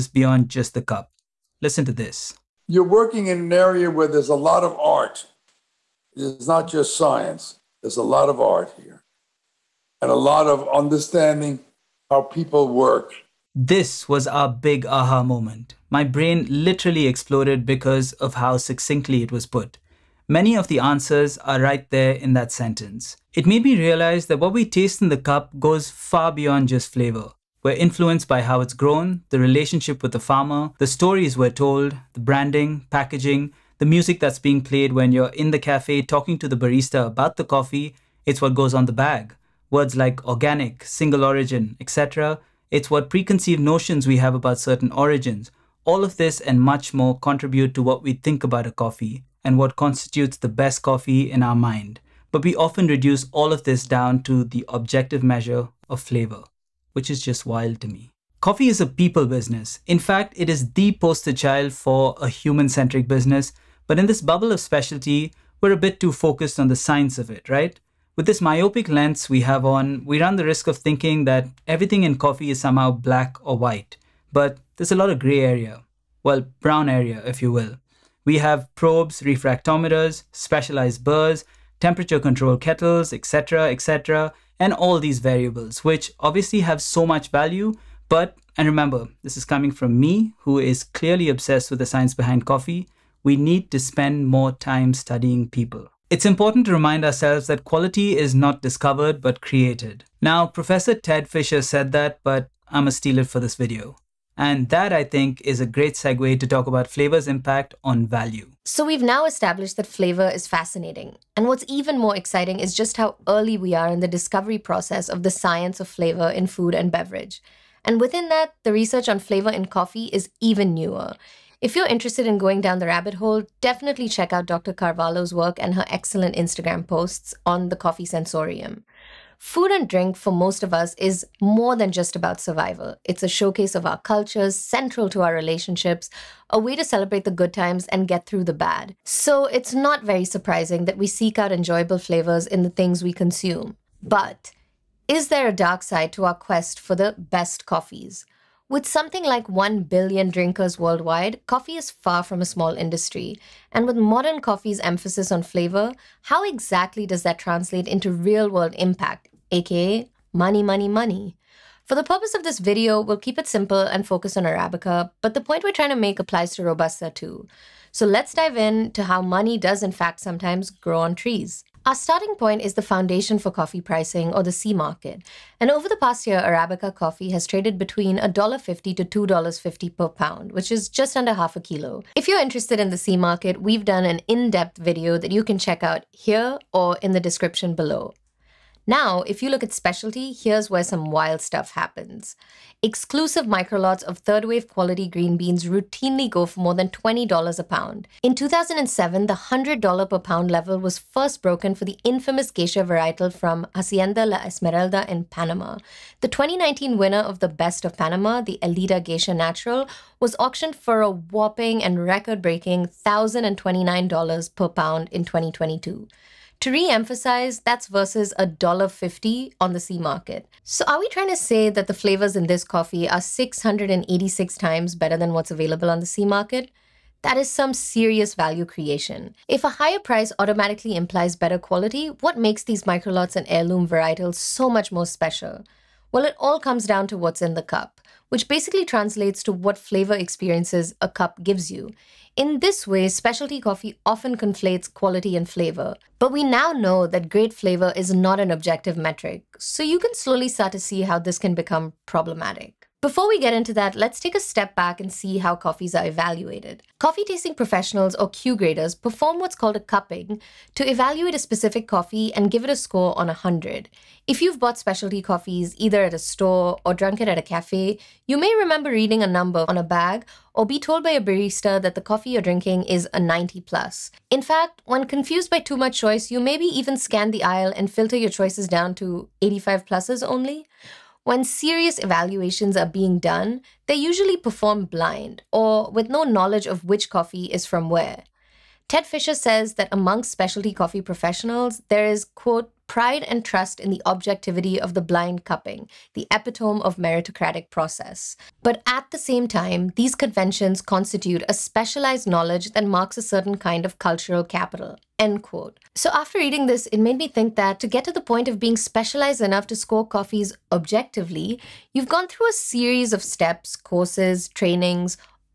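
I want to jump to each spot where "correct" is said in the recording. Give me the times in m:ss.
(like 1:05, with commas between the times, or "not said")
not said.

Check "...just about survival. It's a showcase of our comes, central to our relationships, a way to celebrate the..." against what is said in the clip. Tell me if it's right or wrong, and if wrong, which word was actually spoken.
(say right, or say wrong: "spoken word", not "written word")
wrong: "cultures", not "comes".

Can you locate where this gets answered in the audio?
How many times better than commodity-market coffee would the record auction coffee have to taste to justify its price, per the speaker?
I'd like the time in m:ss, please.
3:43.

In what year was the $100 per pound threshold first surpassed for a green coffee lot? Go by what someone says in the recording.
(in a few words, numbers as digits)
2007.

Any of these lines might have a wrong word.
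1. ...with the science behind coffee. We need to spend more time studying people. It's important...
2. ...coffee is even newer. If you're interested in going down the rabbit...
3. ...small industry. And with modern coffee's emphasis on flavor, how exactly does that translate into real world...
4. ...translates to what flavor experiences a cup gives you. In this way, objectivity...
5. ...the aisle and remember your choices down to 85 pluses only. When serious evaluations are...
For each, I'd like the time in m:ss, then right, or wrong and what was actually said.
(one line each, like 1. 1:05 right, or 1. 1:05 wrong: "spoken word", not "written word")
1. 1:31 right
2. 1:59 right
3. 2:32 right
4. 3:58 wrong: "specialty", not "objectivity"
5. 4:37 wrong: "filter", not "remember".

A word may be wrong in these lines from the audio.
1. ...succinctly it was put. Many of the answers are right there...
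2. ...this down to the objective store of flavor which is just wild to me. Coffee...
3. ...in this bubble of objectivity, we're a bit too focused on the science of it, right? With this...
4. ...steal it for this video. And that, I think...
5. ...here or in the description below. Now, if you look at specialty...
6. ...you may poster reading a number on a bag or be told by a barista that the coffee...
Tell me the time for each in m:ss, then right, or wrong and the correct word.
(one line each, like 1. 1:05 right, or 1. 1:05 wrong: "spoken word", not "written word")
1. 0:18 right
2. 0:53 wrong: "measure", not "store"
3. 1:03 wrong: "specialty", not "objectivity"
4. 1:42 right
5. 3:06 right
6. 4:28 wrong: "remember", not "poster".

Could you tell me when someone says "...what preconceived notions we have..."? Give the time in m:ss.
0:42.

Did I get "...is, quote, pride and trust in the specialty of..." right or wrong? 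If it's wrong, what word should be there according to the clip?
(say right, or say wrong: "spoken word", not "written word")
wrong: "objectivity", not "specialty".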